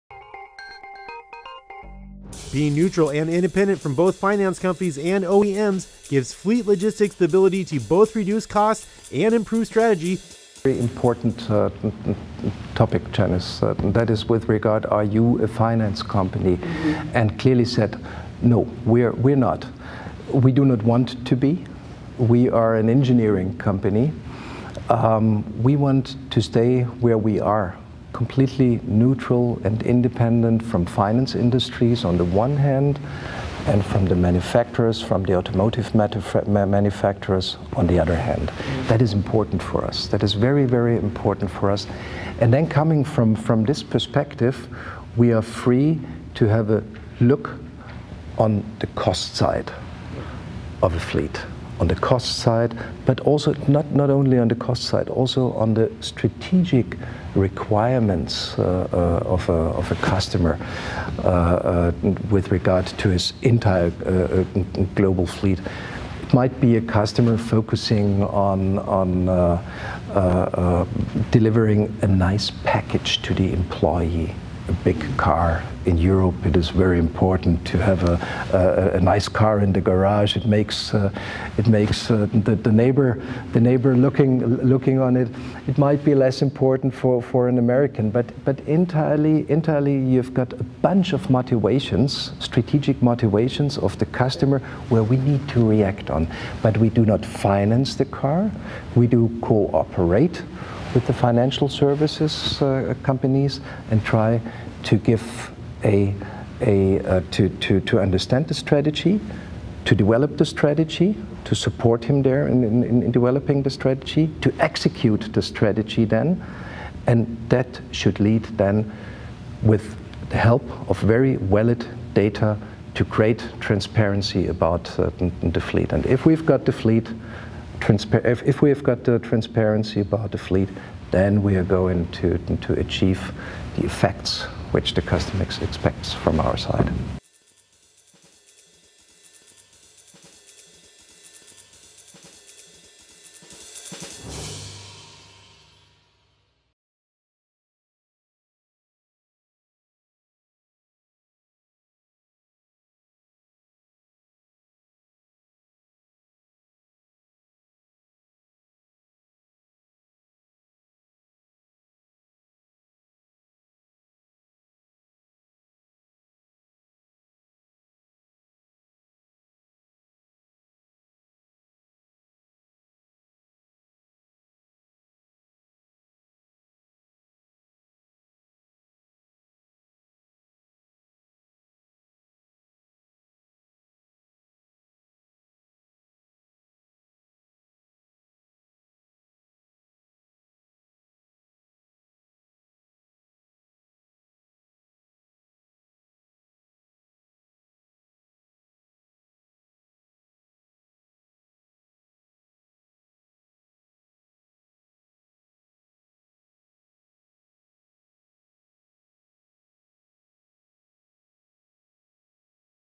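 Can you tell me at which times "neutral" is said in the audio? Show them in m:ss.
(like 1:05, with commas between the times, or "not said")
0:02, 0:28.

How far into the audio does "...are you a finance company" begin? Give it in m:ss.
0:14.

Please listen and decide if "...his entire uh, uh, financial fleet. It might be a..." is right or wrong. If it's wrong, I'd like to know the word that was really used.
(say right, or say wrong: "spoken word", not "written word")
wrong: "global", not "financial".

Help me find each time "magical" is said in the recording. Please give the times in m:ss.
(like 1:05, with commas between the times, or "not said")
not said.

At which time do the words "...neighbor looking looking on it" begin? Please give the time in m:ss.
1:23.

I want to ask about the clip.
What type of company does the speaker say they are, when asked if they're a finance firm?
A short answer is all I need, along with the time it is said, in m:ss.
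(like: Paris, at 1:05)
An engineering company, at 0:22.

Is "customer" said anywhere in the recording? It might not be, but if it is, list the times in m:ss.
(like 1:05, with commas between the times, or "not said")
0:59, 1:06, 1:34, 2:15.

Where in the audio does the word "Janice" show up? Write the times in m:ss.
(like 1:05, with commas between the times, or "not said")
0:13.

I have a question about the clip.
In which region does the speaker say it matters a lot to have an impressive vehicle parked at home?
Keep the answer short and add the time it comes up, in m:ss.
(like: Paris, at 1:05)
Europe, at 1:15.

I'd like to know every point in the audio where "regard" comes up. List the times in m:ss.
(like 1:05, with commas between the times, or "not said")
0:14, 1:02.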